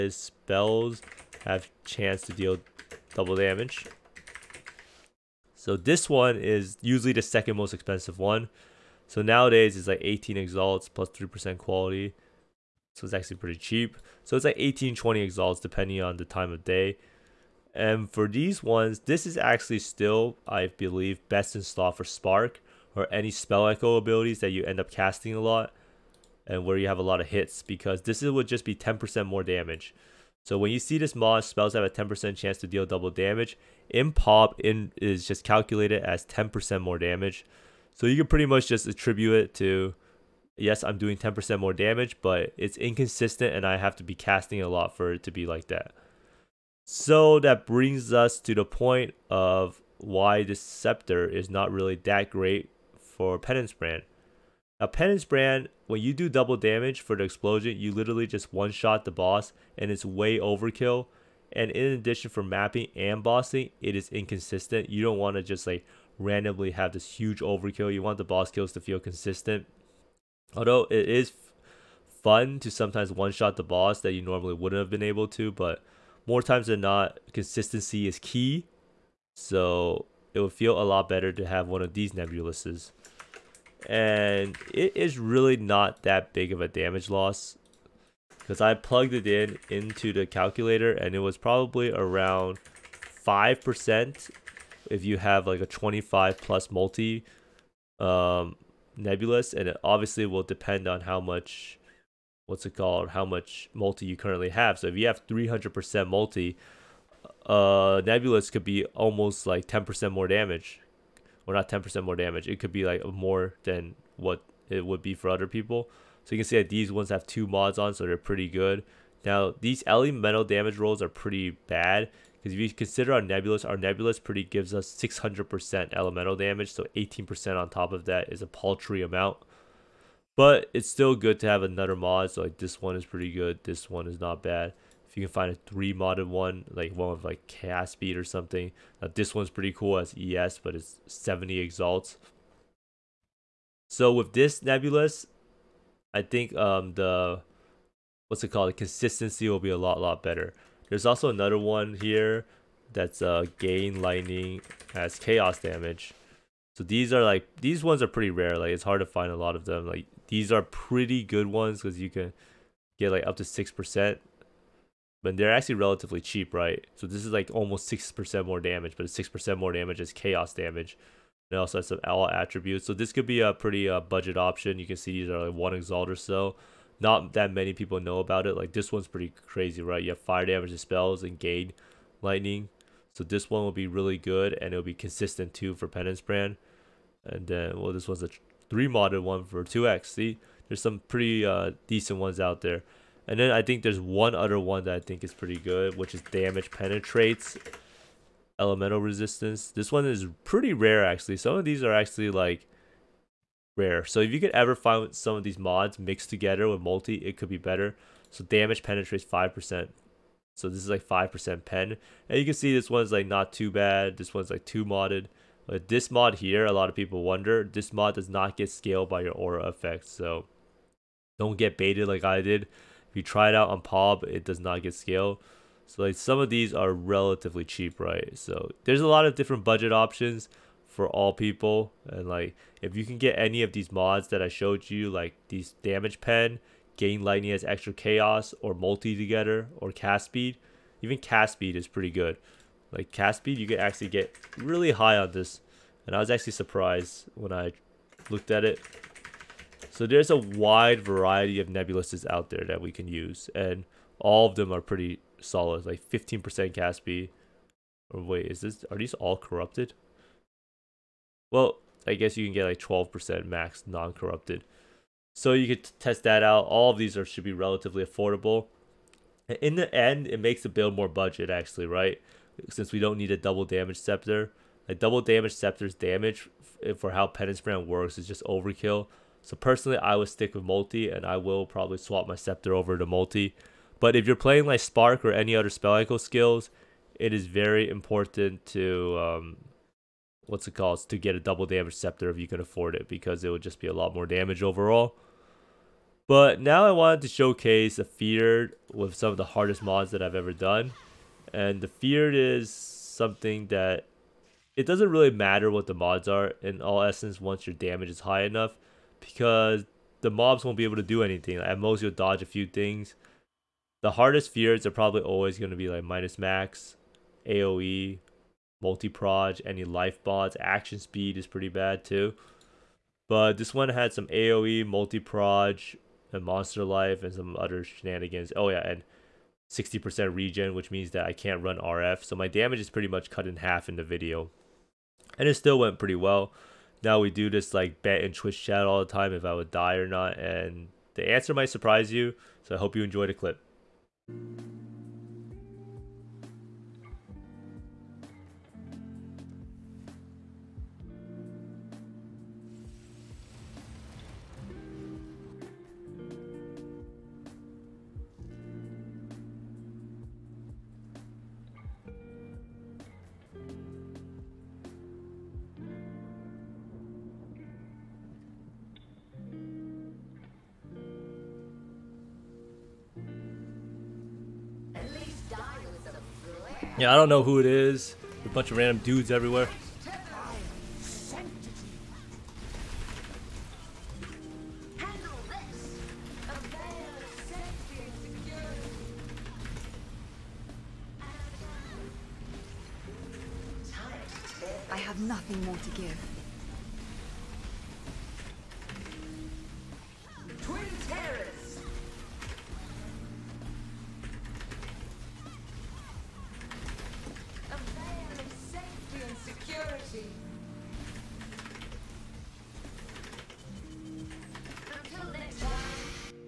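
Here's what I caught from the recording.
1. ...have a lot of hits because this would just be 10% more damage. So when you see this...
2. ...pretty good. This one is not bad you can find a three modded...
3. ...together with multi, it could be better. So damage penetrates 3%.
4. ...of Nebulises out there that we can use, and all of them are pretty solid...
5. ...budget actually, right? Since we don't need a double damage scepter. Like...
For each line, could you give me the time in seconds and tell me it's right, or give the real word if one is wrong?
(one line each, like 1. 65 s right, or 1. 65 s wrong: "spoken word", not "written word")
1. 26 s right
2. 133 s right
3. 206 s wrong: "5", not "3"
4. 251 s right
5. 271 s right.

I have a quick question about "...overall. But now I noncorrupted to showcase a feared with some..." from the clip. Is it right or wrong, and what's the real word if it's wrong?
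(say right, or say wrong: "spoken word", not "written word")
wrong: "wanted", not "noncorrupted".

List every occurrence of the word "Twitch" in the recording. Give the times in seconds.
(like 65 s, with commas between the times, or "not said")
338 s.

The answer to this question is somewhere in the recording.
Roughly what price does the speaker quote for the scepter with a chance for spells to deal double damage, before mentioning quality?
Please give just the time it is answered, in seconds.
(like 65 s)
10 s.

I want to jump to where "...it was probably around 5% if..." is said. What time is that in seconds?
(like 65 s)
91 s.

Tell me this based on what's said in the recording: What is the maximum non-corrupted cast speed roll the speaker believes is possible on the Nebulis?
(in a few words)
12%.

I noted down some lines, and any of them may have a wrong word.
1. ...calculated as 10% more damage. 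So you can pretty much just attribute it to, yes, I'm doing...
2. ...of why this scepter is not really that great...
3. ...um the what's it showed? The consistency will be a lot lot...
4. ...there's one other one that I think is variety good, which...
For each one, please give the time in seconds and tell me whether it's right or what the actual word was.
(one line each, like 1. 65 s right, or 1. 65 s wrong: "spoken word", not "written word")
1. 35 s right
2. 49 s right
3. 146 s wrong: "called", not "showed"
4. 193 s wrong: "pretty", not "variety".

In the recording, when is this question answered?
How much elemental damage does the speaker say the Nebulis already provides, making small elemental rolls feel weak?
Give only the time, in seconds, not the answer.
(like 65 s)
124 s.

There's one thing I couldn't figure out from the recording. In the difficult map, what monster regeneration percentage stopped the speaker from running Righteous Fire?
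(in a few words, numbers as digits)
60%.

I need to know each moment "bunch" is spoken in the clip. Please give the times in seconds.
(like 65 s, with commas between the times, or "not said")
378 s.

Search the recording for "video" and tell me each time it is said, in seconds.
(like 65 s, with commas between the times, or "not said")
334 s.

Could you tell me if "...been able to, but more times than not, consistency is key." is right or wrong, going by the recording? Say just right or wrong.
right.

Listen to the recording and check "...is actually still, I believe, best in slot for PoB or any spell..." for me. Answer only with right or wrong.
wrong.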